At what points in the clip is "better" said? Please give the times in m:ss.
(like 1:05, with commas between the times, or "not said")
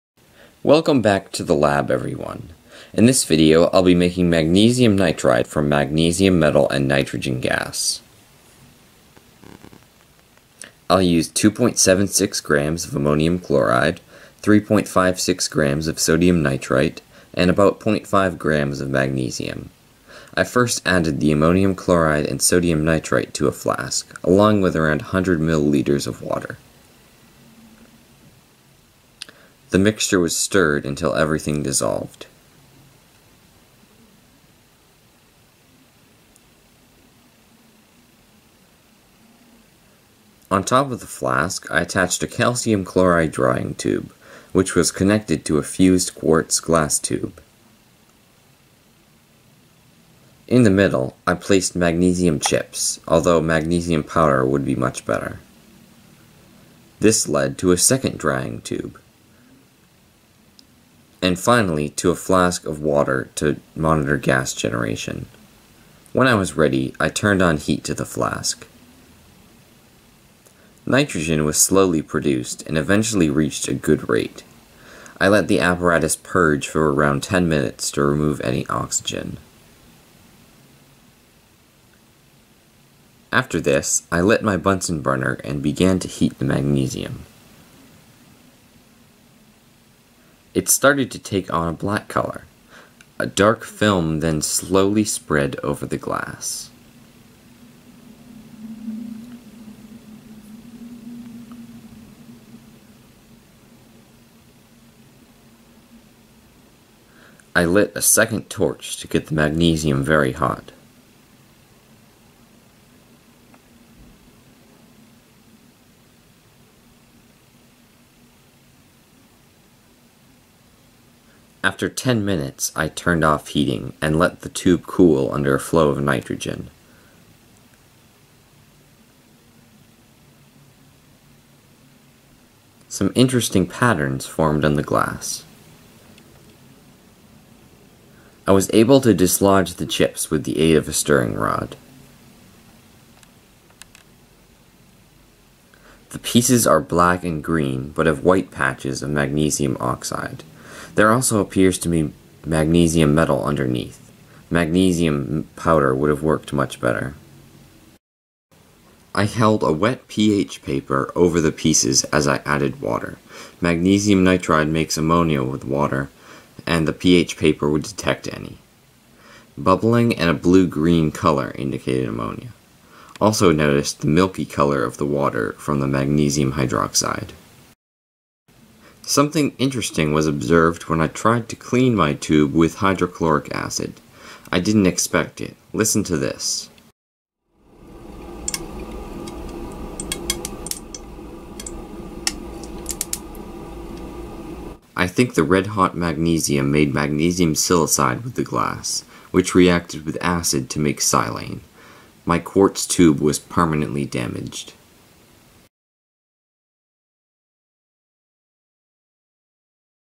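0:55, 2:36.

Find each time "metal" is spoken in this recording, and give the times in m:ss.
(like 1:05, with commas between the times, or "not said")
0:06, 2:33.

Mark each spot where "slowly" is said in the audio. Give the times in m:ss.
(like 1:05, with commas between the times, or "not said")
1:11, 1:34.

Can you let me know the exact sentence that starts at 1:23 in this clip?
After this, I lit my Bunsen burner and began to heat the magnesium.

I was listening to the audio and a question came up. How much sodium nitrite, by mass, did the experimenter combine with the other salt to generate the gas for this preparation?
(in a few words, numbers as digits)
3.56 grams.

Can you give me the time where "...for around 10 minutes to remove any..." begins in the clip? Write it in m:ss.
1:16.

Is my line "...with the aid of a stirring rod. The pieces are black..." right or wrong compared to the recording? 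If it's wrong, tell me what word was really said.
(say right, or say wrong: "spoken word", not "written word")
right.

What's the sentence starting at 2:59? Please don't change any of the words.
Something interesting was observed when I tried to clean my tube with hydrochloric acid.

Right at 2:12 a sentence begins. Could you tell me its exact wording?
Some interesting patterns formed on the glass.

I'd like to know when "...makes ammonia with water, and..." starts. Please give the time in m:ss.
2:44.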